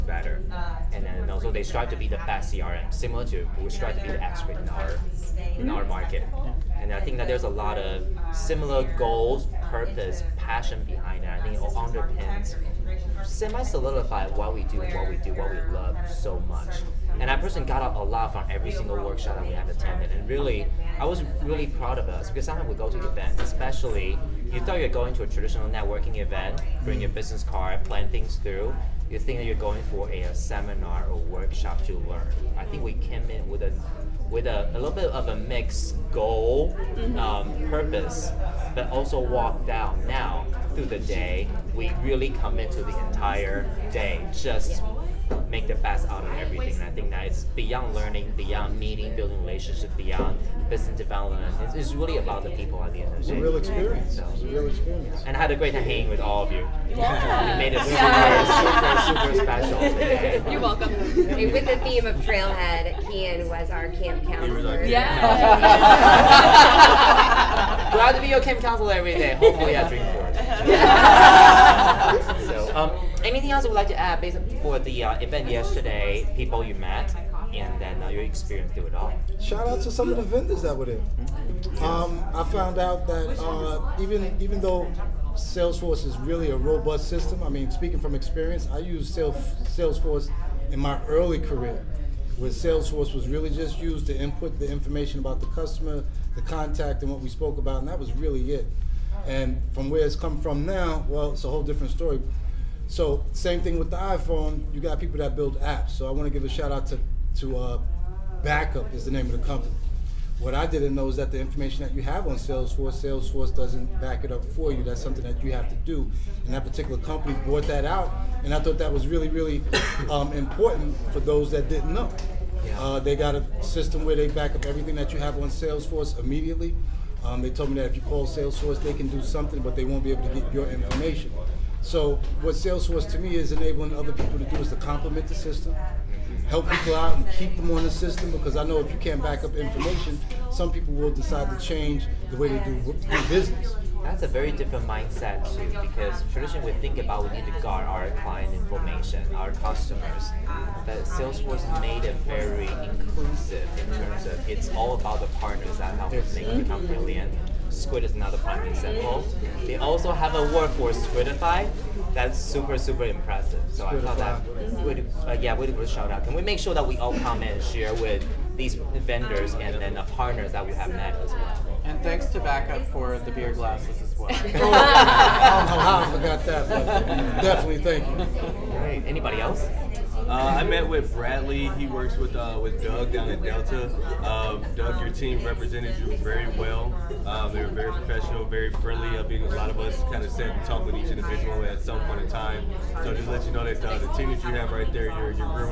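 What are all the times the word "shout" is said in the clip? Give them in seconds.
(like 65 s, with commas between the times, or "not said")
79 s, 106 s, 165 s.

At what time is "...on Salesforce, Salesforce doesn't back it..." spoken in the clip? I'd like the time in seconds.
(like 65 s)
112 s.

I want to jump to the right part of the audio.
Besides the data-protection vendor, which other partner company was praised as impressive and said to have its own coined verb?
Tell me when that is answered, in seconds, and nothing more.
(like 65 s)
157 s.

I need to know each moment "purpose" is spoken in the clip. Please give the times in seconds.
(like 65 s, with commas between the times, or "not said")
9 s, 37 s.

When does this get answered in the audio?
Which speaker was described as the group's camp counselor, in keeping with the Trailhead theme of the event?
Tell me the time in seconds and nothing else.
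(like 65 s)
63 s.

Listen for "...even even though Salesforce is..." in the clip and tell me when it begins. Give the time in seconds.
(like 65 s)
83 s.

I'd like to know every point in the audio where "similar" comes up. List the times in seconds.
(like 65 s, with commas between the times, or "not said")
2 s, 8 s.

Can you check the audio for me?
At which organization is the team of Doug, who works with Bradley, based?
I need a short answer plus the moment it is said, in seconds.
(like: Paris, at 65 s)
Delta, at 183 s.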